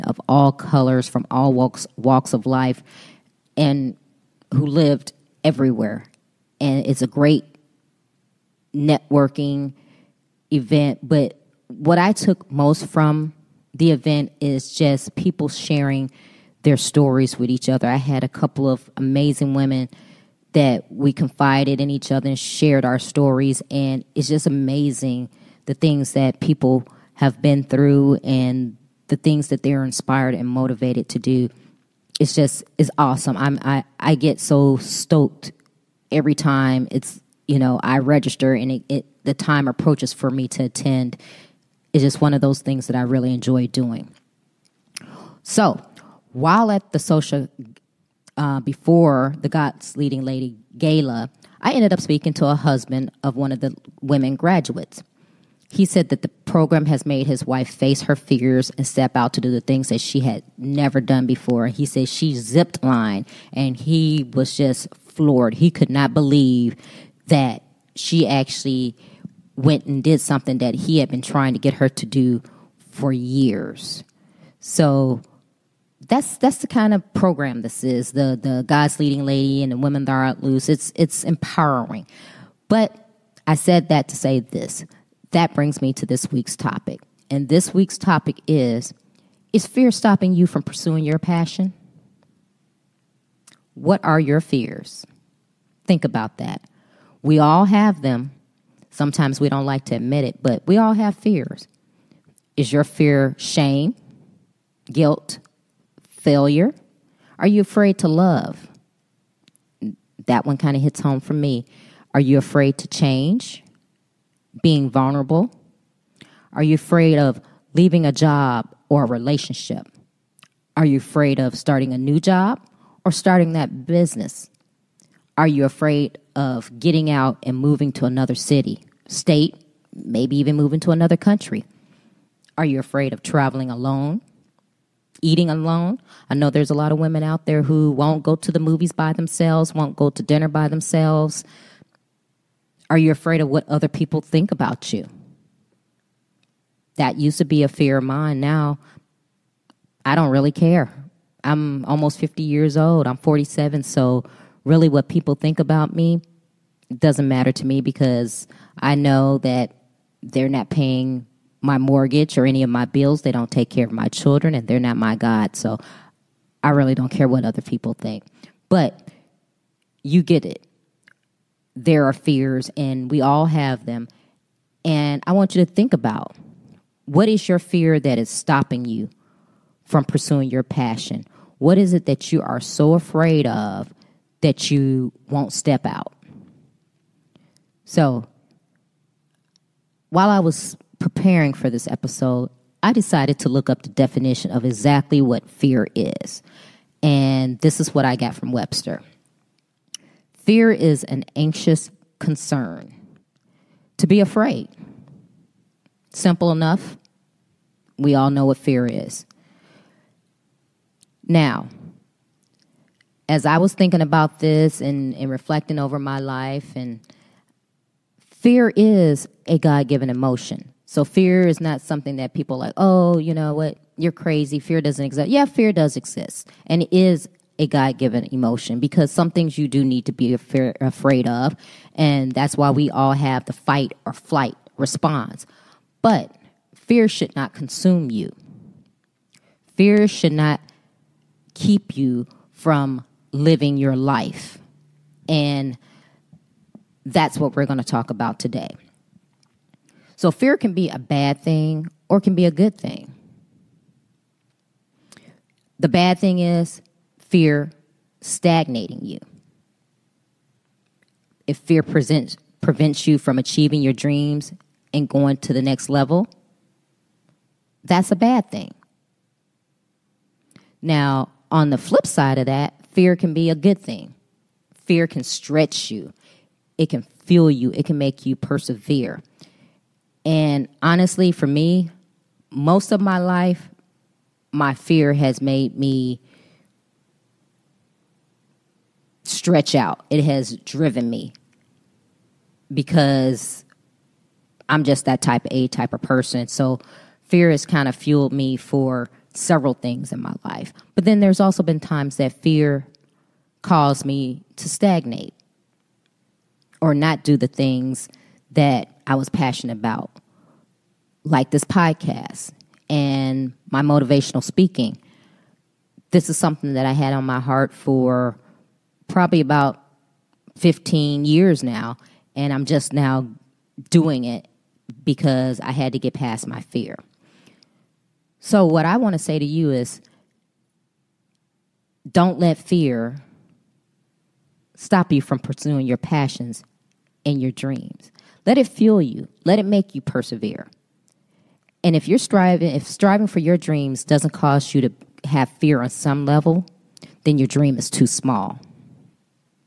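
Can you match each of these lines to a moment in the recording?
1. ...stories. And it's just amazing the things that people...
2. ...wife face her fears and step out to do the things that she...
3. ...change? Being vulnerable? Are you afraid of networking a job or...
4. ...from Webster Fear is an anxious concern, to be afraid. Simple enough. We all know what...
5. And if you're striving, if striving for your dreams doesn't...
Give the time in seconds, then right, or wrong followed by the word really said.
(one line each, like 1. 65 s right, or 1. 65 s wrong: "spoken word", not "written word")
1. 22 s right
2. 57 s right
3. 112 s wrong: "leaving", not "networking"
4. 198 s right
5. 341 s right.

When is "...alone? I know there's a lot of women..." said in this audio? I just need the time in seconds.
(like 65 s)
135 s.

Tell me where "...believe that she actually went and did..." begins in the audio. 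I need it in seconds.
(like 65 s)
66 s.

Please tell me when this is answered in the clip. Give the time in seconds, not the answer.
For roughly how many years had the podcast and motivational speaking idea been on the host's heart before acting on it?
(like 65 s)
320 s.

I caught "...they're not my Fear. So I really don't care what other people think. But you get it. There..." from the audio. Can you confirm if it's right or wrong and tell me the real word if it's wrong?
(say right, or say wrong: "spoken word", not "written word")
wrong: "God", not "Fear".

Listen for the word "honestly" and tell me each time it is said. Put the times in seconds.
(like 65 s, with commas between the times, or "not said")
280 s.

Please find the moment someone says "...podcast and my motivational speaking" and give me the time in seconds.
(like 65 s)
311 s.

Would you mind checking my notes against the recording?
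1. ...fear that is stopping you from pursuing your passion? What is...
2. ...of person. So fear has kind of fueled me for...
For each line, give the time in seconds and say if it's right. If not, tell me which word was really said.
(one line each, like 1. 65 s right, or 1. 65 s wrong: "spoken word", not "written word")
1. 177 s right
2. 295 s right.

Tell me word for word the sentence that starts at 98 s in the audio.
Sometimes we don't like to admit it, but we all have fears.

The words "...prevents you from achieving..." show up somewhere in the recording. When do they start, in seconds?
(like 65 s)
262 s.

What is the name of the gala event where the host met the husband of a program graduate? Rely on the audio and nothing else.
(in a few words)
God's Leading Lady Gala.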